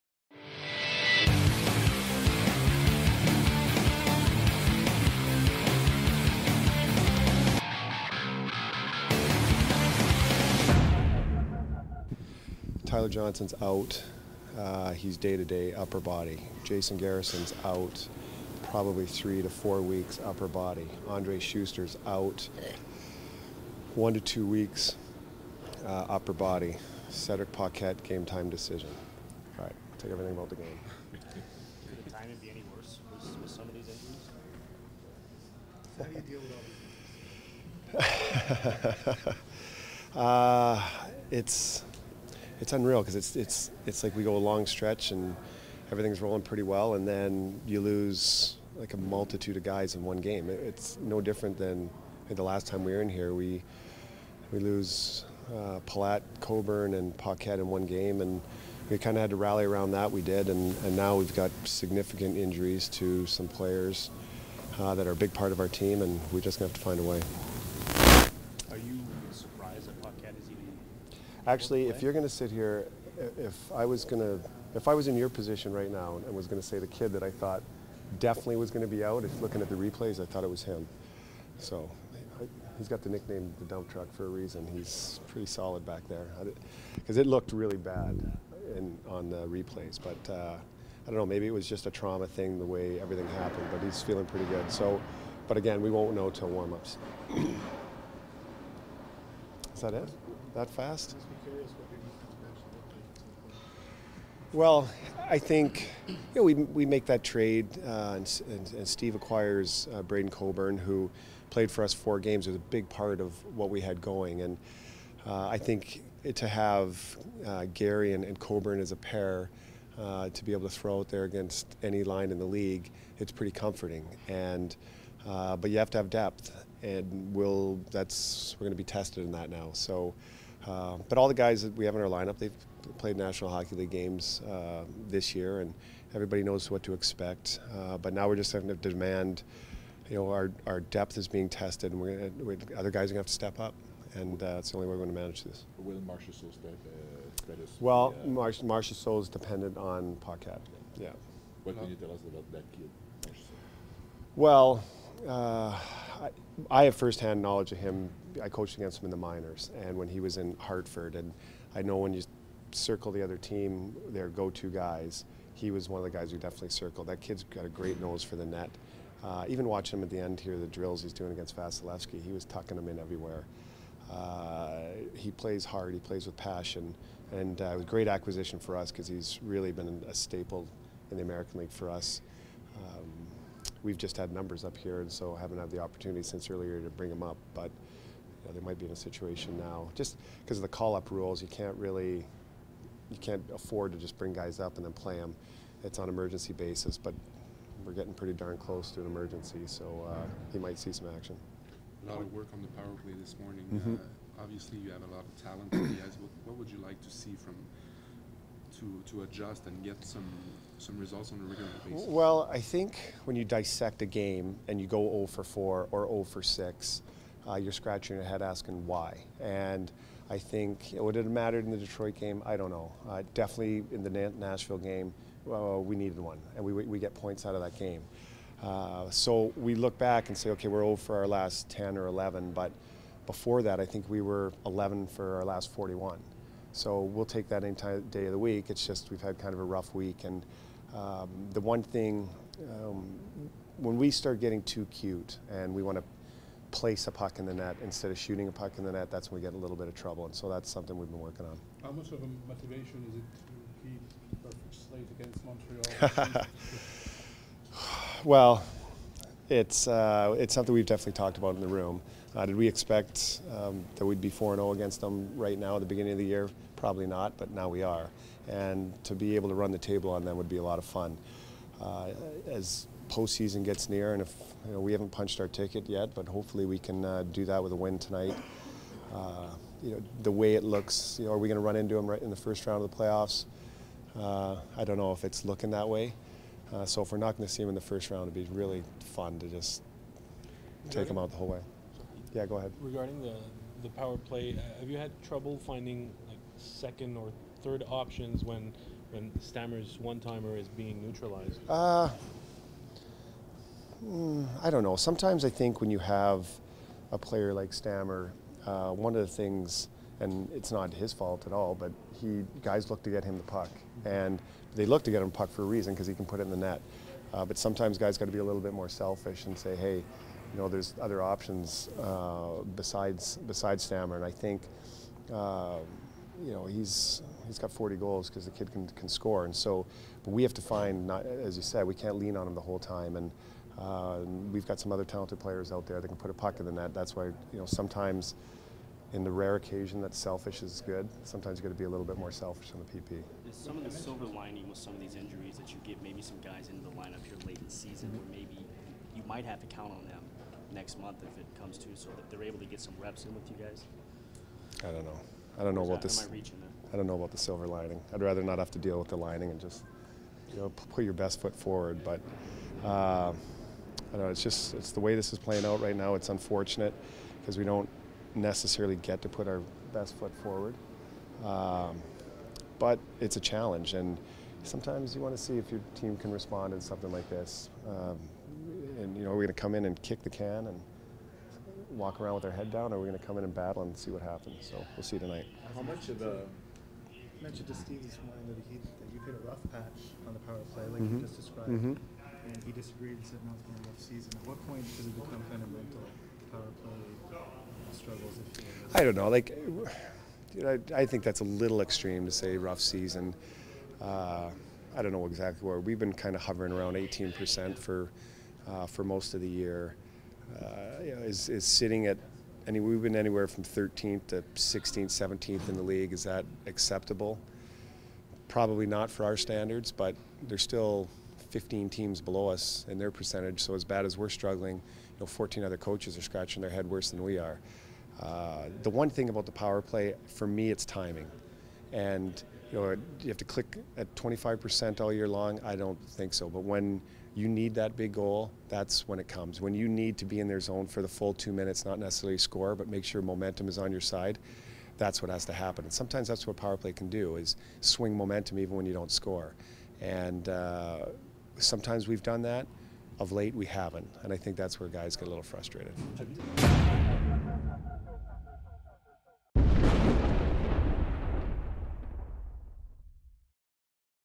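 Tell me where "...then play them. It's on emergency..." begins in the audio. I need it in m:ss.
3:14.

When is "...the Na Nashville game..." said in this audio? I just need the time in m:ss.
3:44.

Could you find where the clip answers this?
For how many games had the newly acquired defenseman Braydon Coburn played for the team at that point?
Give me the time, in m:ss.
1:51.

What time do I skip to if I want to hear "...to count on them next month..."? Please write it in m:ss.
5:49.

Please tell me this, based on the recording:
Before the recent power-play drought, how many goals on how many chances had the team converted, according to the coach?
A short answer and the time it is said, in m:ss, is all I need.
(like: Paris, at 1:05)
11 for 41, at 3:54.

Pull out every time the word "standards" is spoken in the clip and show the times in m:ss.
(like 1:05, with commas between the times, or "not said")
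6:59.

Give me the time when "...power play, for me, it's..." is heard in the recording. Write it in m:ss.
7:09.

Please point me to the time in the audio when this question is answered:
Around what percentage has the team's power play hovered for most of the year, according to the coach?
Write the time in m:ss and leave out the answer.
6:46.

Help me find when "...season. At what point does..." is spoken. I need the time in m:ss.
6:34.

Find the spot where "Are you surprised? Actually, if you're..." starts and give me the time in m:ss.
1:08.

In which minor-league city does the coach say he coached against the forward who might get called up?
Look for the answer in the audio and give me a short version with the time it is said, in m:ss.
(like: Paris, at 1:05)
Hartford, at 2:40.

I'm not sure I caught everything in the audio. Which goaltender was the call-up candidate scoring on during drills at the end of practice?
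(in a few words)
Vasilevskiy.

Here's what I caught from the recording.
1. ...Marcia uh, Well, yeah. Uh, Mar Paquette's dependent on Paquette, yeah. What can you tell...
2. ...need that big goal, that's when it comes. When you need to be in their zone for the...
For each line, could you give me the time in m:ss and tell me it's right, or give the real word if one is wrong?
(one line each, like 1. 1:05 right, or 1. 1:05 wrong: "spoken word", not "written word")
1. 2:26 wrong: "Marchessault", not "Paquette"
2. 7:17 right.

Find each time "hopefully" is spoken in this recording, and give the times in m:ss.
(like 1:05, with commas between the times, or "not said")
4:36.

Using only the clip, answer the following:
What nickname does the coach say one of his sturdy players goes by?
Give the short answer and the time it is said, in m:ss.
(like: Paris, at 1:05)
the dump truck, at 1:23.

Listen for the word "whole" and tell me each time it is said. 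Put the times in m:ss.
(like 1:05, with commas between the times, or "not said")
4:51, 5:32.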